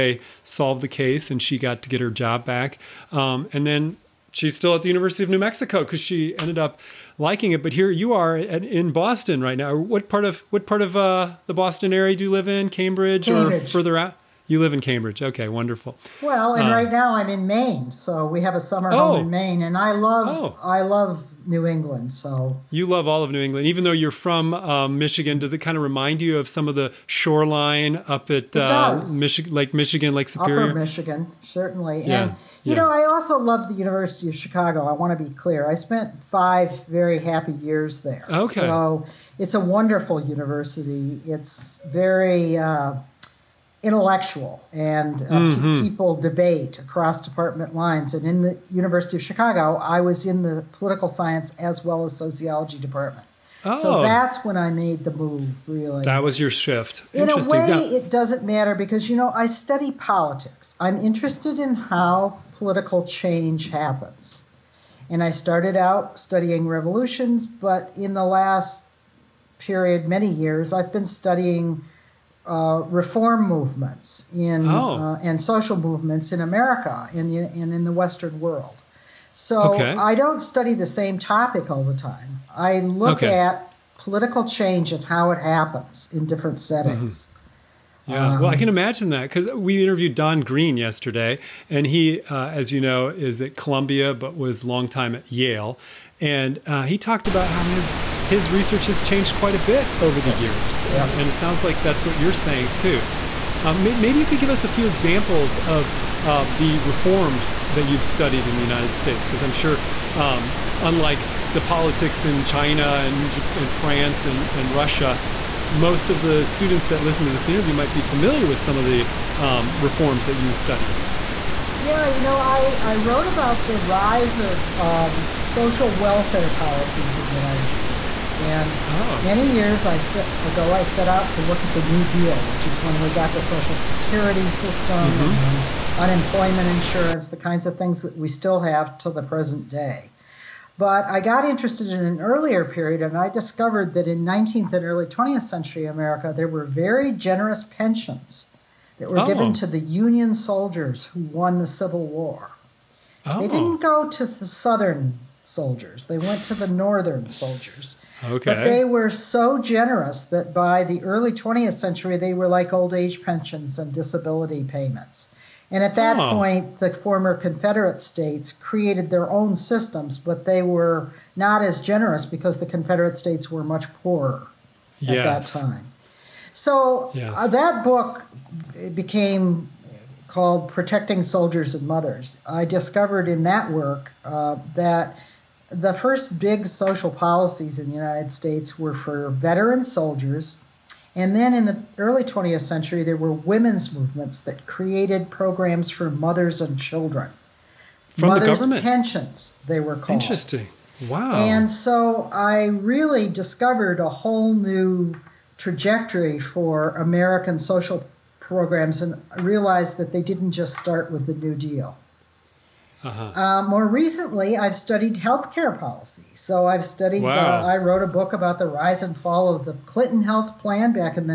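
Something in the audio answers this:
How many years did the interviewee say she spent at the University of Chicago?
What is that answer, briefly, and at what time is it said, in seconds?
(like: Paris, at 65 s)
5, at 36 s.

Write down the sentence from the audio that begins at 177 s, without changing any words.
uh, that book became called Protecting Soldiers and Mothers.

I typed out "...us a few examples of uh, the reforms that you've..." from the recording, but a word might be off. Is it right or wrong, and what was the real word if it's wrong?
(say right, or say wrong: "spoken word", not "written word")
right.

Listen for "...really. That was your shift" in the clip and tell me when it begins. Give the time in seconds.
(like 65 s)
55 s.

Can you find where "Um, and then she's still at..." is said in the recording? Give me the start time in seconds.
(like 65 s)
3 s.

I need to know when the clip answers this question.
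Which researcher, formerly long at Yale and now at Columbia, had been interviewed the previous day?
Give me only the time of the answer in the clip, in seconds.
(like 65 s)
90 s.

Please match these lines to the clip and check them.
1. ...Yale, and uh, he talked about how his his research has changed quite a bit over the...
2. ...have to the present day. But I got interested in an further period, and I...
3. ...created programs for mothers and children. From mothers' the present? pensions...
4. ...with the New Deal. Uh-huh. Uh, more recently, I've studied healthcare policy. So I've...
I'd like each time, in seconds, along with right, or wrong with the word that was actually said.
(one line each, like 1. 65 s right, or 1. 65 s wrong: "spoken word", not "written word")
1. 95 s right
2. 138 s wrong: "earlier", not "further"
3. 194 s wrong: "government", not "present"
4. 211 s right.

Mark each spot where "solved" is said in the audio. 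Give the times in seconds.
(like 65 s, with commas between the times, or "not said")
0 s.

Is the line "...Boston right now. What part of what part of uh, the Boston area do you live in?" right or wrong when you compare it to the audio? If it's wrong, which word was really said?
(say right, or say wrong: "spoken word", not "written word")
right.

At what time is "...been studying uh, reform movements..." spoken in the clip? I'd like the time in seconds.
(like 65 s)
70 s.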